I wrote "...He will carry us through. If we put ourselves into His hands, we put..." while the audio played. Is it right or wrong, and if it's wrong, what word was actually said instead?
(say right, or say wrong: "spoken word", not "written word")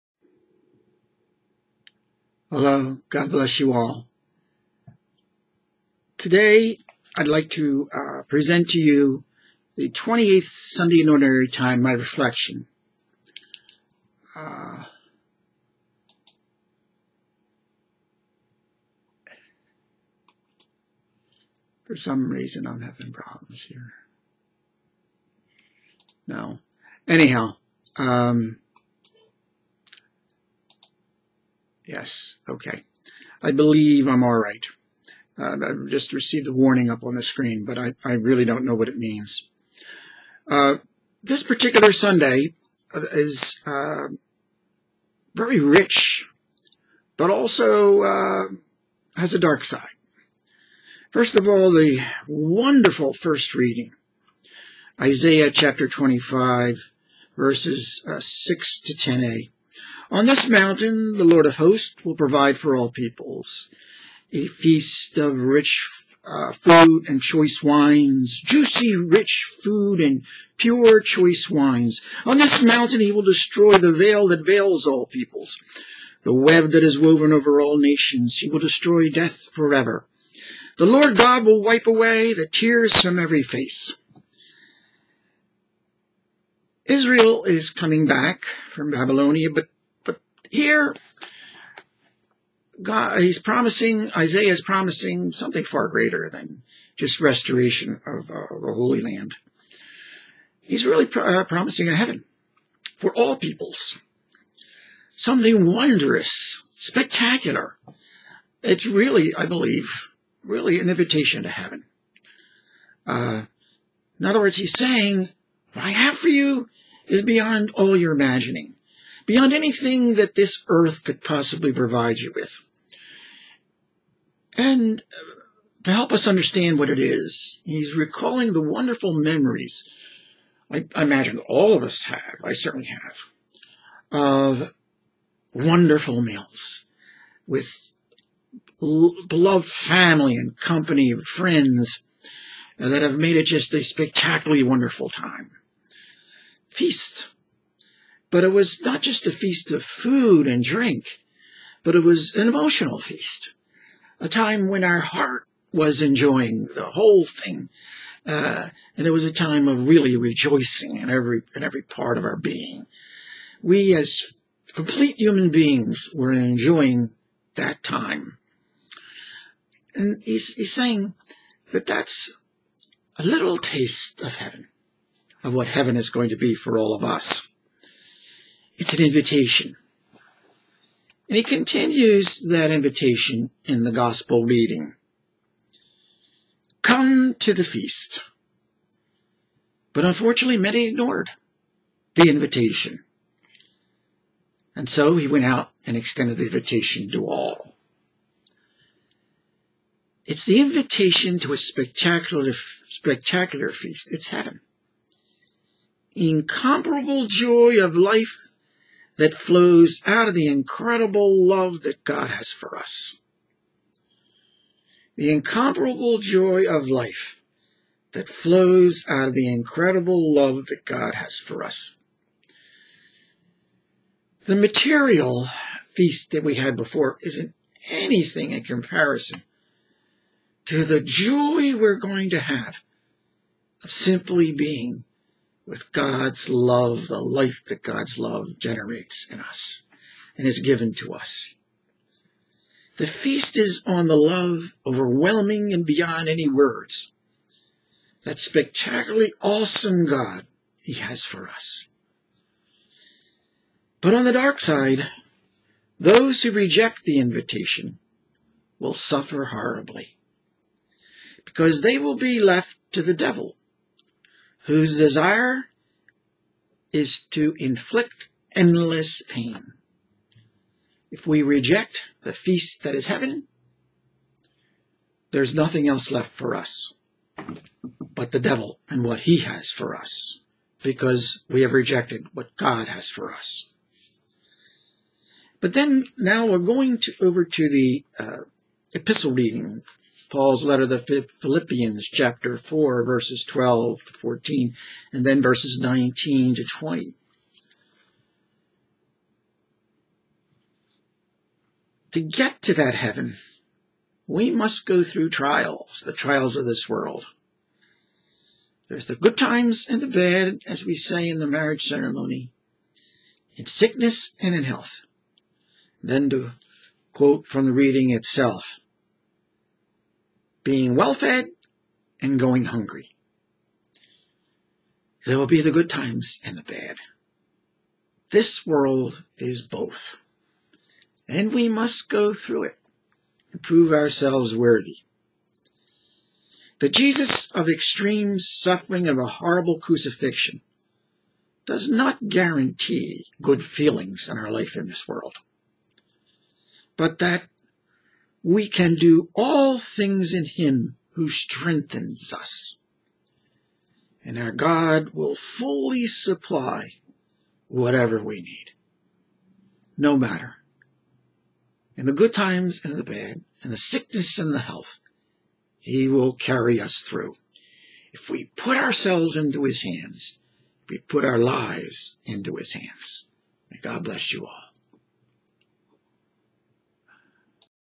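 right.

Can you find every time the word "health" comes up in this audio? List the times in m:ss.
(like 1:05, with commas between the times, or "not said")
5:14, 6:04.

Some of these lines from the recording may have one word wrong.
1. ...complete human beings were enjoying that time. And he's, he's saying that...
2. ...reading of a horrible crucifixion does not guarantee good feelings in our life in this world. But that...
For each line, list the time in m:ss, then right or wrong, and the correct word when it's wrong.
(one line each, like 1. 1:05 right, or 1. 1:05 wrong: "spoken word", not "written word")
1. 2:44 right
2. 5:38 wrong: "suffering", not "reading".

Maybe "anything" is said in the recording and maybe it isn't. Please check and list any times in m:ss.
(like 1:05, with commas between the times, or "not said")
1:59, 3:47.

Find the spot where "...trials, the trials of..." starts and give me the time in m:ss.
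5:05.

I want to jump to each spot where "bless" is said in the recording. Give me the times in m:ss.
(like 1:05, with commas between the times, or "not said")
0:03, 6:14.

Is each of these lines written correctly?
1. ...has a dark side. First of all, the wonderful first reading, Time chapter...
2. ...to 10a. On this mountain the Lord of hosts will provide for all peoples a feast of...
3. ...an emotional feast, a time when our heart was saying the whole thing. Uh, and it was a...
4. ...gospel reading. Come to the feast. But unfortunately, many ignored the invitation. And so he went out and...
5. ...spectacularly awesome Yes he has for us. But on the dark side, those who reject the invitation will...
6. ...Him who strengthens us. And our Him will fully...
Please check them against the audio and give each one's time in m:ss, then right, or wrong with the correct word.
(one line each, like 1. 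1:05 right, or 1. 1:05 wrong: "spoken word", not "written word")
1. 0:49 wrong: "Isaiah", not "Time"
2. 0:58 right
3. 2:32 wrong: "enjoying", not "saying"
4. 3:03 right
5. 4:08 wrong: "God", not "Yes"
6. 5:50 wrong: "God", not "Him".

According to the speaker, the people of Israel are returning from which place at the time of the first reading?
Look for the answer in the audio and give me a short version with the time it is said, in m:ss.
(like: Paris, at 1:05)
Babylonia, at 1:28.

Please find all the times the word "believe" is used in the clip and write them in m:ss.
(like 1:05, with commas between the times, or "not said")
0:33, 1:49.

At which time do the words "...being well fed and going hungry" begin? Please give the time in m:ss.
5:20.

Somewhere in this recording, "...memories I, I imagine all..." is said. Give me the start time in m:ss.
2:09.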